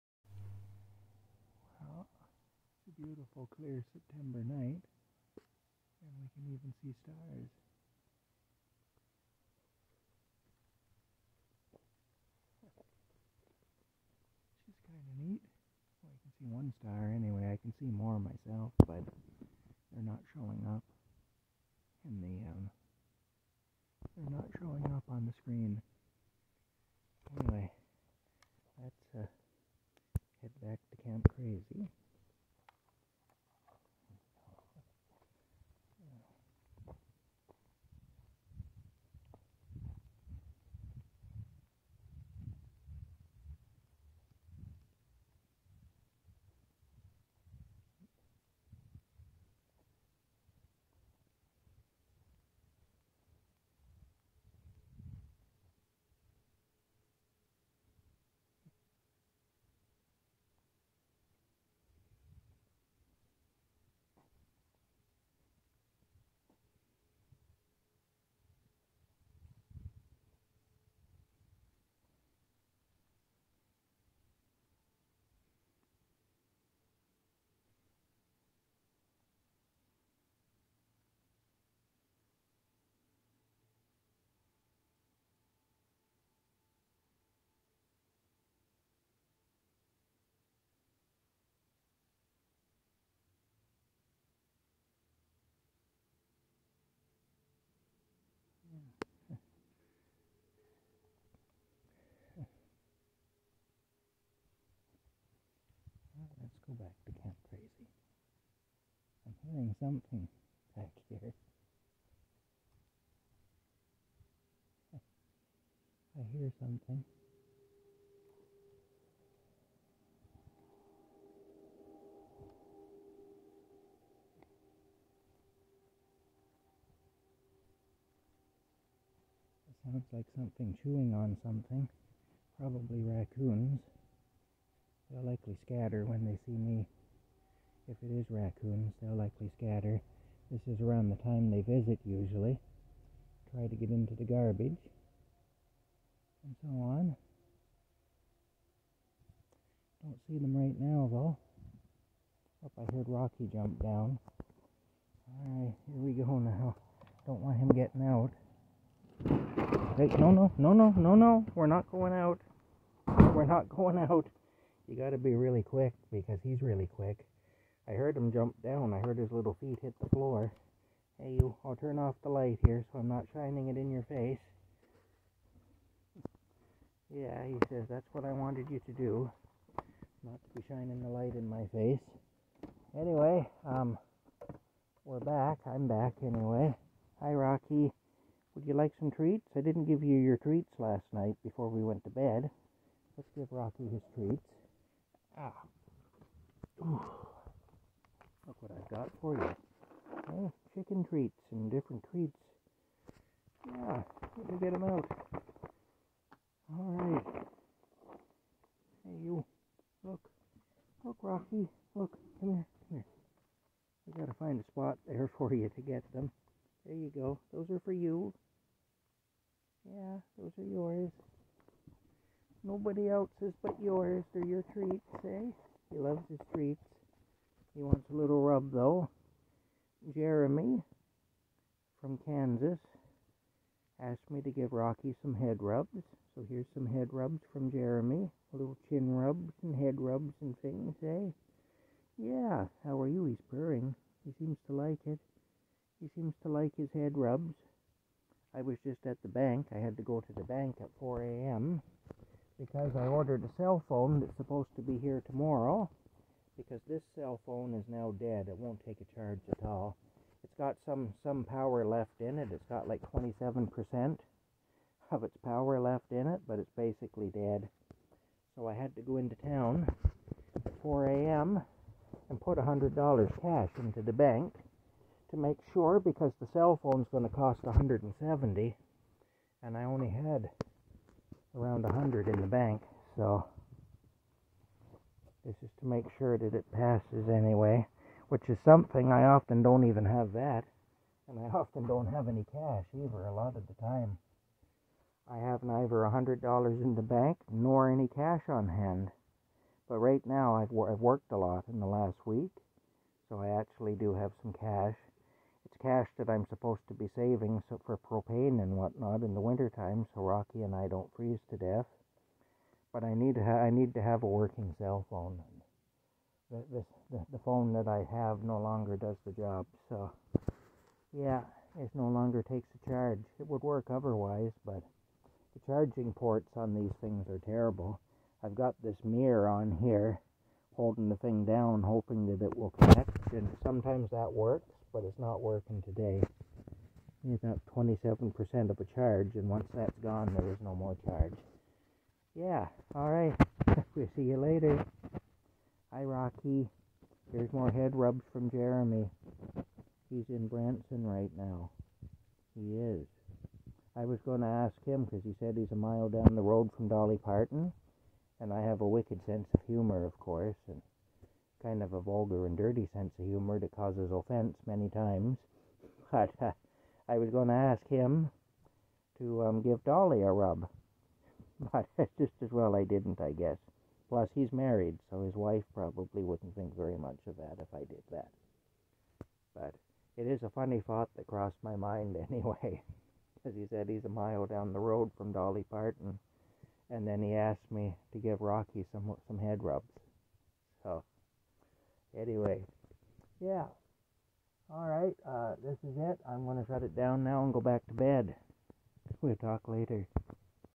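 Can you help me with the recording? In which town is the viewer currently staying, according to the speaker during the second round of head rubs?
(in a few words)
Branson.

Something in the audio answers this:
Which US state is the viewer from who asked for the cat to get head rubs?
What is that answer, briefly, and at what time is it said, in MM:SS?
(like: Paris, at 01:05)
Kansas, at 03:52.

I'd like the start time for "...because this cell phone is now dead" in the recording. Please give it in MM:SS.
04:16.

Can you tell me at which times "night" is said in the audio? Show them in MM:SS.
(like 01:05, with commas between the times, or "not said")
00:04, 03:11.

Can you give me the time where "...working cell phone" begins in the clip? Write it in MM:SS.
05:14.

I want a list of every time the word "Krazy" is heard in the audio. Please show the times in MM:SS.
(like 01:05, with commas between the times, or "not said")
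01:47.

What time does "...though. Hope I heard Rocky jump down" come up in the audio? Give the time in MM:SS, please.
02:31.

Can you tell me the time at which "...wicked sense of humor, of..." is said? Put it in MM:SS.
05:58.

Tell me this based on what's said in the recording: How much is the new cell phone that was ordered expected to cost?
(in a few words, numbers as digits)
170.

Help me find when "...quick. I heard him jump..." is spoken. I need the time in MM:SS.
02:46.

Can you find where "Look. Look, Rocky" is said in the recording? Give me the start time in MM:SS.
03:30.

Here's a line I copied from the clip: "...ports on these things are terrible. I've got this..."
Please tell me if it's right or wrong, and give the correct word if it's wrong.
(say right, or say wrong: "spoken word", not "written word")
right.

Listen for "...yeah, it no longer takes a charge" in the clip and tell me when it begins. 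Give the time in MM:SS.
05:21.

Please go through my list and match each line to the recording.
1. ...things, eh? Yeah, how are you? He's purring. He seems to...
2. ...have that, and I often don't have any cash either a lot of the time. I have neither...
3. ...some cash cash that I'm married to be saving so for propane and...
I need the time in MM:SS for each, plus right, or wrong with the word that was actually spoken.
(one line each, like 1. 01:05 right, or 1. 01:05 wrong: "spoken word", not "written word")
1. 04:00 right
2. 04:50 right
3. 05:04 wrong: "supposed", not "married".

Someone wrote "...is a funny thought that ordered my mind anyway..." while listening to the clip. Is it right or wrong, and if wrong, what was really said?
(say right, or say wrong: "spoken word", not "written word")
wrong: "crossed", not "ordered".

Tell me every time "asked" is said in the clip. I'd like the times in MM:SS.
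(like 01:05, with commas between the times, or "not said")
03:53, 06:27.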